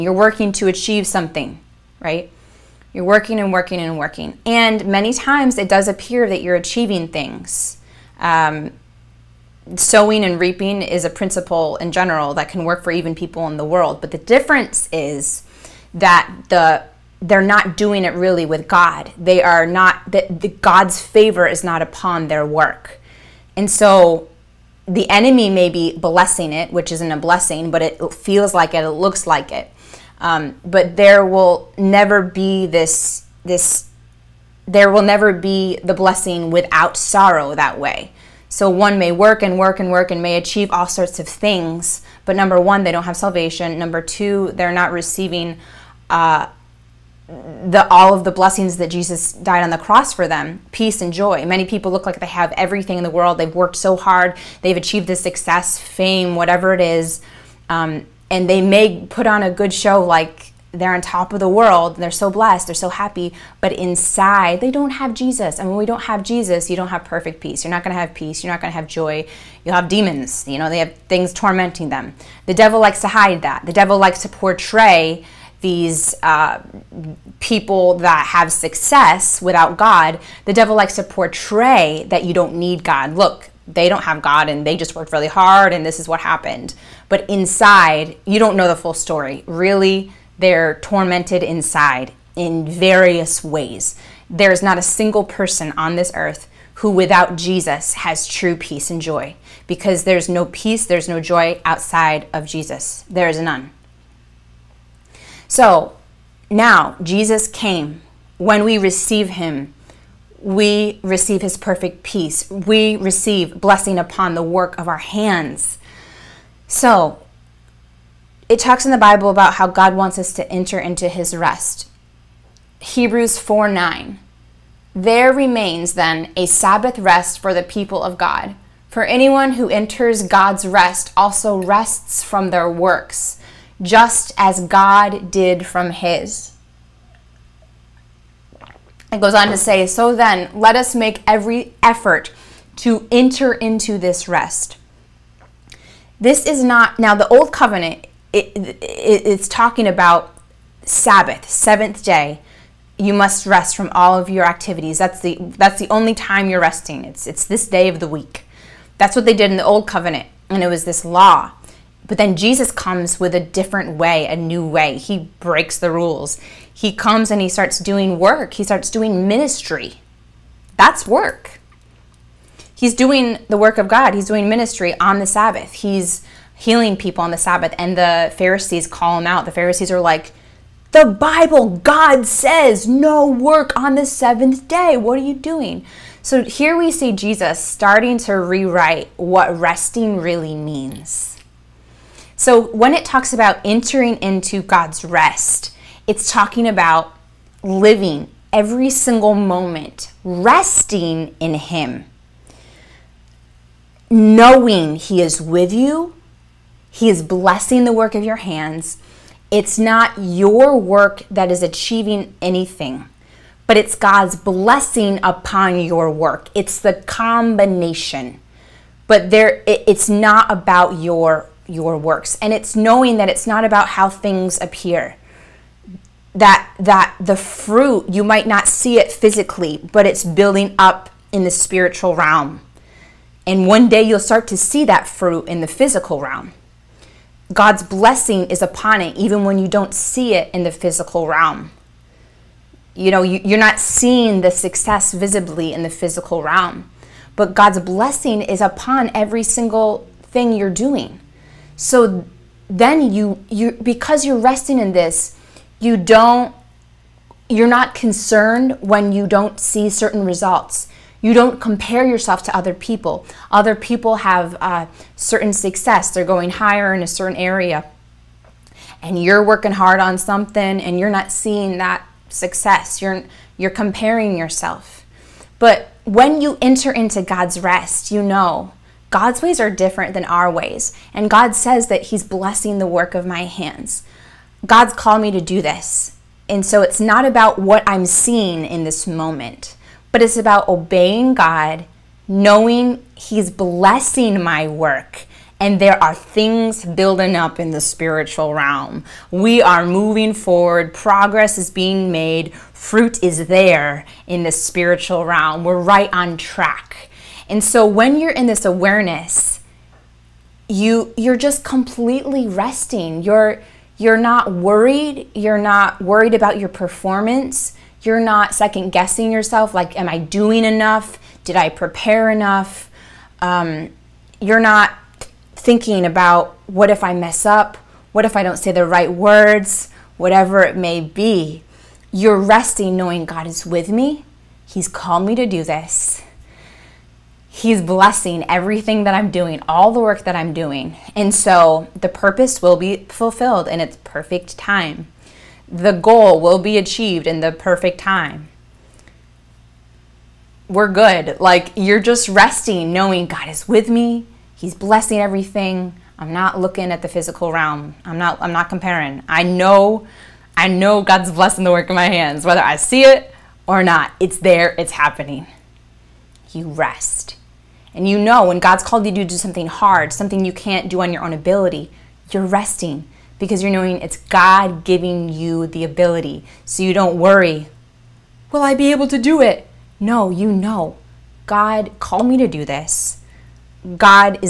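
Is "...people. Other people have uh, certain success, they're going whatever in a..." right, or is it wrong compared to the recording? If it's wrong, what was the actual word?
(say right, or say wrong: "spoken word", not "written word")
wrong: "higher", not "whatever".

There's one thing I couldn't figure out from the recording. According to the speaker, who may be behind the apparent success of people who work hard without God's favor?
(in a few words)
The enemy.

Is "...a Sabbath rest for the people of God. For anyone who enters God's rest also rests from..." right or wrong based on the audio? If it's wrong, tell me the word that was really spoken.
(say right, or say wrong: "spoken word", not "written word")
right.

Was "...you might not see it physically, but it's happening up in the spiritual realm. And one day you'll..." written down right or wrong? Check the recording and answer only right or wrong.
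wrong.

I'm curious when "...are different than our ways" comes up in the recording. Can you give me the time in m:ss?
4:39.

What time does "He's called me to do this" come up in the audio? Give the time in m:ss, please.
5:34.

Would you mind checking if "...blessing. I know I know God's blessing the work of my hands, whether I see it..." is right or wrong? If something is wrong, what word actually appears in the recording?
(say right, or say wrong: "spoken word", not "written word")
wrong: "comparing", not "blessing".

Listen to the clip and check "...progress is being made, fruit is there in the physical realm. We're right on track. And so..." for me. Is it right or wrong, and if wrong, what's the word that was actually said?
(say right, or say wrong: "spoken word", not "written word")
wrong: "spiritual", not "physical".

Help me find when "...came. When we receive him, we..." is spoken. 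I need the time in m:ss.
1:47.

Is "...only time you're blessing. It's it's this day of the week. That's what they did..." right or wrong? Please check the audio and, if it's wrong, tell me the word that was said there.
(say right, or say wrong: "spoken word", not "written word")
wrong: "resting", not "blessing".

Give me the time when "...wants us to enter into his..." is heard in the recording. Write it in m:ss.
1:59.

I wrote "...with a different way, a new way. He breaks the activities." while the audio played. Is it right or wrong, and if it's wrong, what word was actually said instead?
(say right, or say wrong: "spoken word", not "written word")
wrong: "rules", not "activities".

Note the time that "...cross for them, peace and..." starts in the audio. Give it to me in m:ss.
0:49.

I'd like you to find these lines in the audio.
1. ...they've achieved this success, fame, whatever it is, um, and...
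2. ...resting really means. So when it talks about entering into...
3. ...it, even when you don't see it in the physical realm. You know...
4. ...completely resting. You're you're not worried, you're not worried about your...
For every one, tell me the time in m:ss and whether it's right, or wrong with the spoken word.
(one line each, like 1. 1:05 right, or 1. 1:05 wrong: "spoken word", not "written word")
1. 0:54 right
2. 3:09 right
3. 3:59 right
4. 5:11 right.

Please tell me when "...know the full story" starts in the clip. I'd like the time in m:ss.
1:28.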